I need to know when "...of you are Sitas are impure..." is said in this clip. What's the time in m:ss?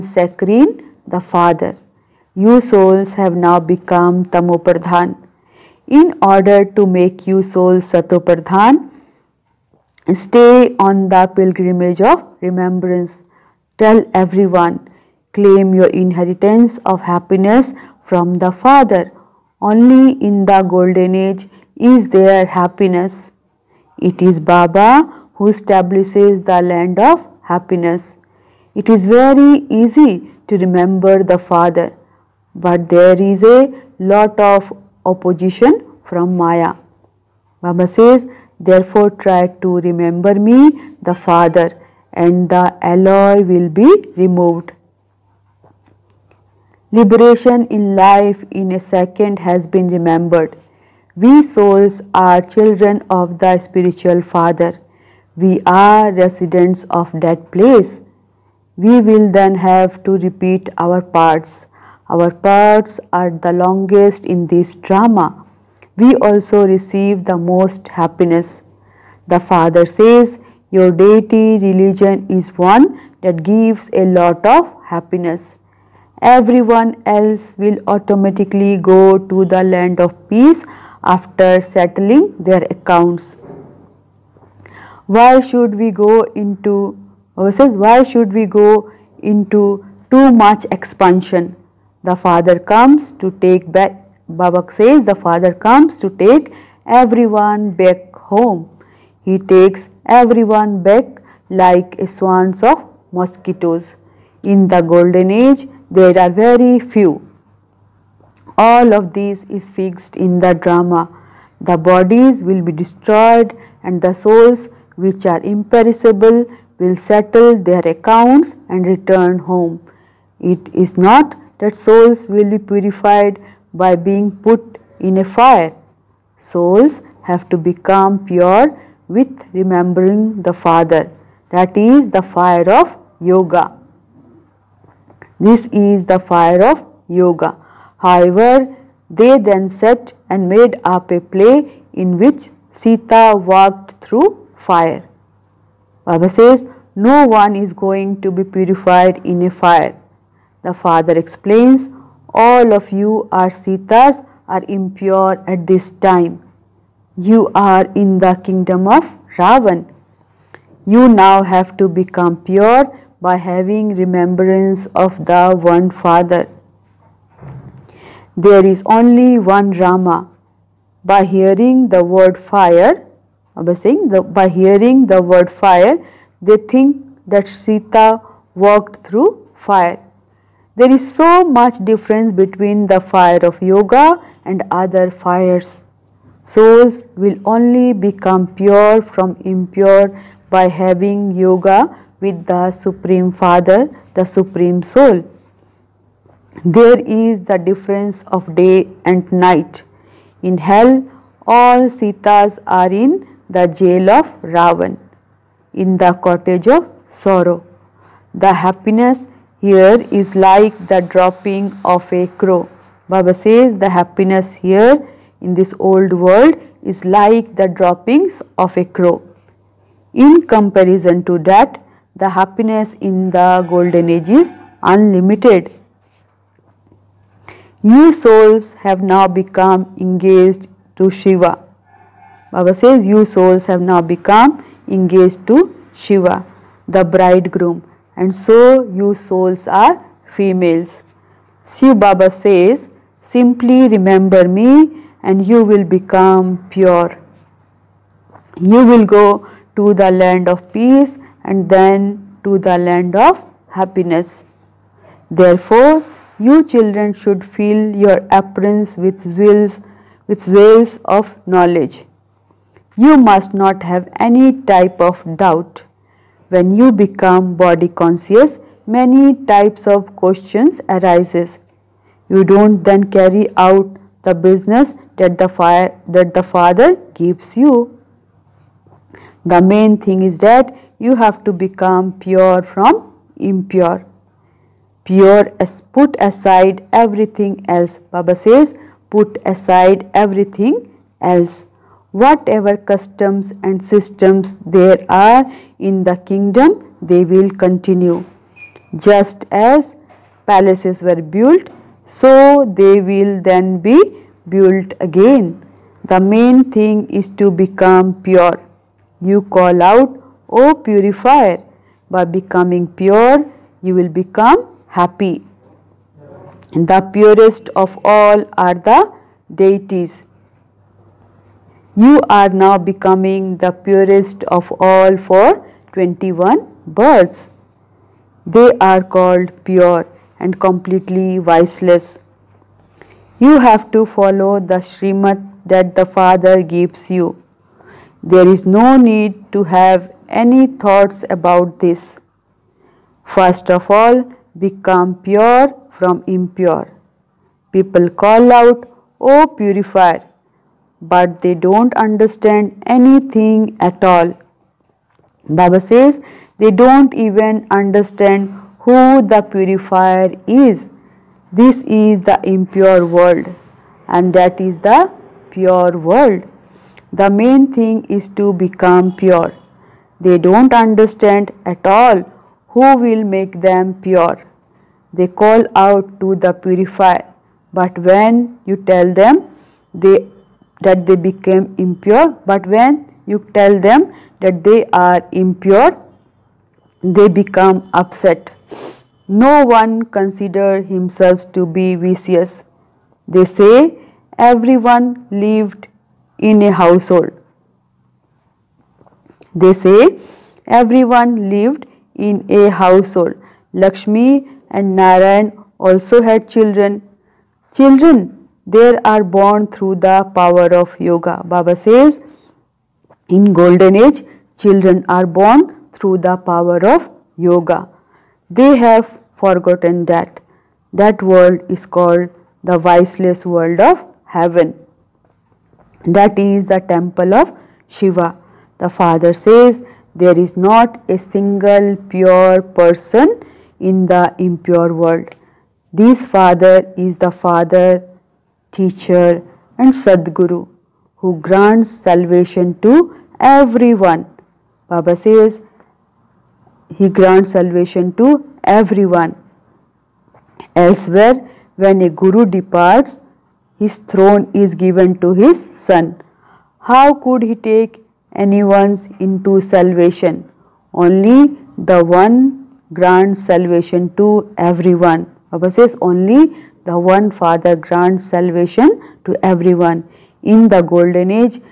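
2:32.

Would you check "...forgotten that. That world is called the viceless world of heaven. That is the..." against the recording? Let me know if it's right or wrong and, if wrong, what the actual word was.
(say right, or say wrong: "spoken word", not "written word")
right.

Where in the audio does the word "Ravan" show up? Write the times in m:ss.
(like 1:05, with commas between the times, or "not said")
2:39, 3:24.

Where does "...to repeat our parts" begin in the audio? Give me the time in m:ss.
1:00.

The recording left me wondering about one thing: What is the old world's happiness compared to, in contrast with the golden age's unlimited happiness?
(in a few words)
Droppings of a crow.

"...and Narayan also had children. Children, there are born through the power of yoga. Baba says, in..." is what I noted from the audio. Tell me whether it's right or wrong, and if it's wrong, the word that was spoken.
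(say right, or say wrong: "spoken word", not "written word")
right.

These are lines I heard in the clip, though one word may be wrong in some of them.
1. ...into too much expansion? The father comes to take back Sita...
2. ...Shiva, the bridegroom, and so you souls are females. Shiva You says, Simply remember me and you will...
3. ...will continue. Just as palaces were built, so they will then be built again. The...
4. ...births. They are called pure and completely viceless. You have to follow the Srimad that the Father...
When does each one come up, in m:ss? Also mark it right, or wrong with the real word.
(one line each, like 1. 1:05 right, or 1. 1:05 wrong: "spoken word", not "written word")
1. 1:29 wrong: "Baba", not "Sita"
2. 3:55 wrong: "Baba", not "You"
3. 4:57 right
4. 5:26 right.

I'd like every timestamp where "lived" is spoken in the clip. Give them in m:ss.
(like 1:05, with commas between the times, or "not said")
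6:35, 6:41.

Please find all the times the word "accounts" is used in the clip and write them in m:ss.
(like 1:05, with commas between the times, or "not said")
1:22, 1:57.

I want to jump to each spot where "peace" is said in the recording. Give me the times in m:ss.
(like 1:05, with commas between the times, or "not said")
1:20, 4:10.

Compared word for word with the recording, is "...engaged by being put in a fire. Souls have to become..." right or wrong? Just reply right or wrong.
wrong.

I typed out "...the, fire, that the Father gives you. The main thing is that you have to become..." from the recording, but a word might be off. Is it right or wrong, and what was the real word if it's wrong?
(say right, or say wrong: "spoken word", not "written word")
right.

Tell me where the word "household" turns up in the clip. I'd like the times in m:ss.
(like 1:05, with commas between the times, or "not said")
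6:36, 6:42.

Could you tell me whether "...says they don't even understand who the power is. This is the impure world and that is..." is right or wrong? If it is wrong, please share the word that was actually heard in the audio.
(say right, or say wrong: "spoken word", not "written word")
wrong: "purifier", not "power".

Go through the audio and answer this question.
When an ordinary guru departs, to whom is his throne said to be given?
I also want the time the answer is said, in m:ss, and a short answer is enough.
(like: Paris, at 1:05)
His son, at 7:35.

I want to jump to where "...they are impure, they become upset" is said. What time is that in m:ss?
6:24.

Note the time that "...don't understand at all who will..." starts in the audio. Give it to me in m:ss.
6:10.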